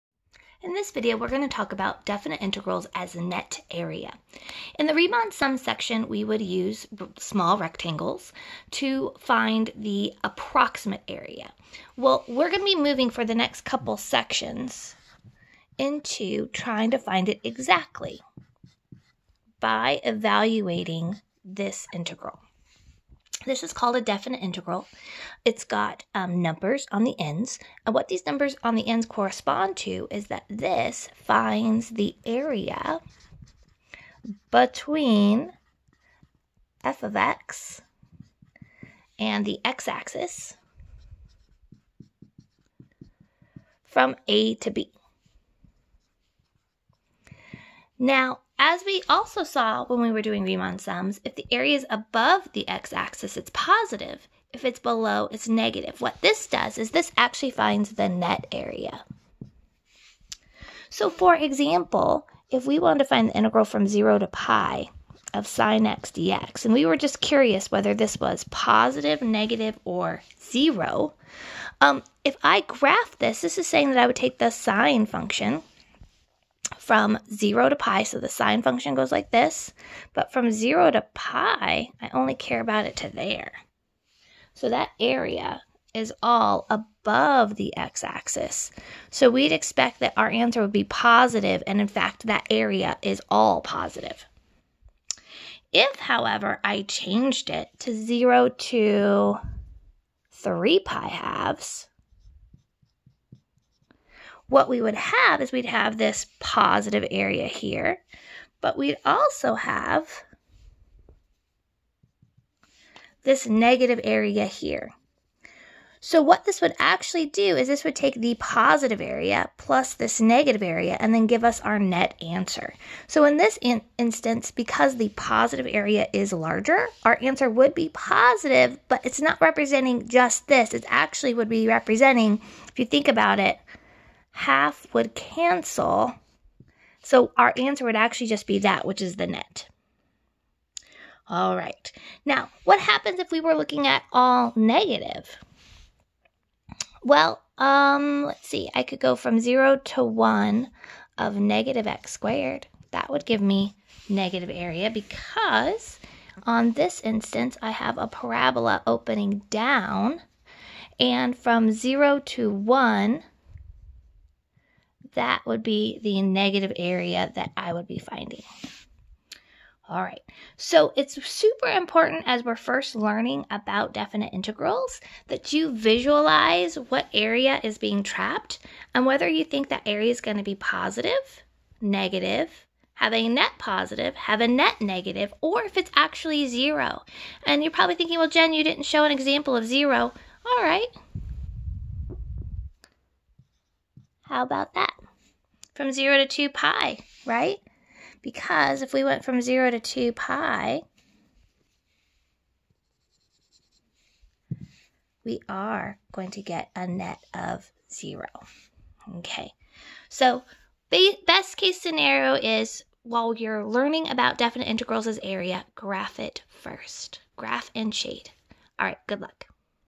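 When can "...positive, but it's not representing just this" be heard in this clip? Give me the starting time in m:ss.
2:07.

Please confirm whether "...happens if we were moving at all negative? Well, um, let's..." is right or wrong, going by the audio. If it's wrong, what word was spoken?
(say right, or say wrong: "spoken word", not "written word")
wrong: "looking", not "moving".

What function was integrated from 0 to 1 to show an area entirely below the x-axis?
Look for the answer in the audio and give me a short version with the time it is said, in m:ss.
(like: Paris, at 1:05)
negative x squared, at 2:31.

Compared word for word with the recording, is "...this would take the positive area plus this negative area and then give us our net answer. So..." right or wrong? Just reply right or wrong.
right.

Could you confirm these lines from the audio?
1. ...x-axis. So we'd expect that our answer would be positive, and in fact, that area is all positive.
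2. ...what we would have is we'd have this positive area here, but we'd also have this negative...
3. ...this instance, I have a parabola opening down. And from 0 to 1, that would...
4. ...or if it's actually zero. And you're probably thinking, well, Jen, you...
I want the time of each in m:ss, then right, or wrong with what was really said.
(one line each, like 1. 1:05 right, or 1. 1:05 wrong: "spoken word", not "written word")
1. 1:27 right
2. 1:44 right
3. 2:36 right
4. 3:05 right.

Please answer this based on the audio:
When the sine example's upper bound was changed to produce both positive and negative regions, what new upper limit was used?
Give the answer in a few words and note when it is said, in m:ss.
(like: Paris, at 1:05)
3 pi halves, at 1:40.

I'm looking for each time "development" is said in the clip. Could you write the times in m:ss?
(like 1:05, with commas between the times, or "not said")
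not said.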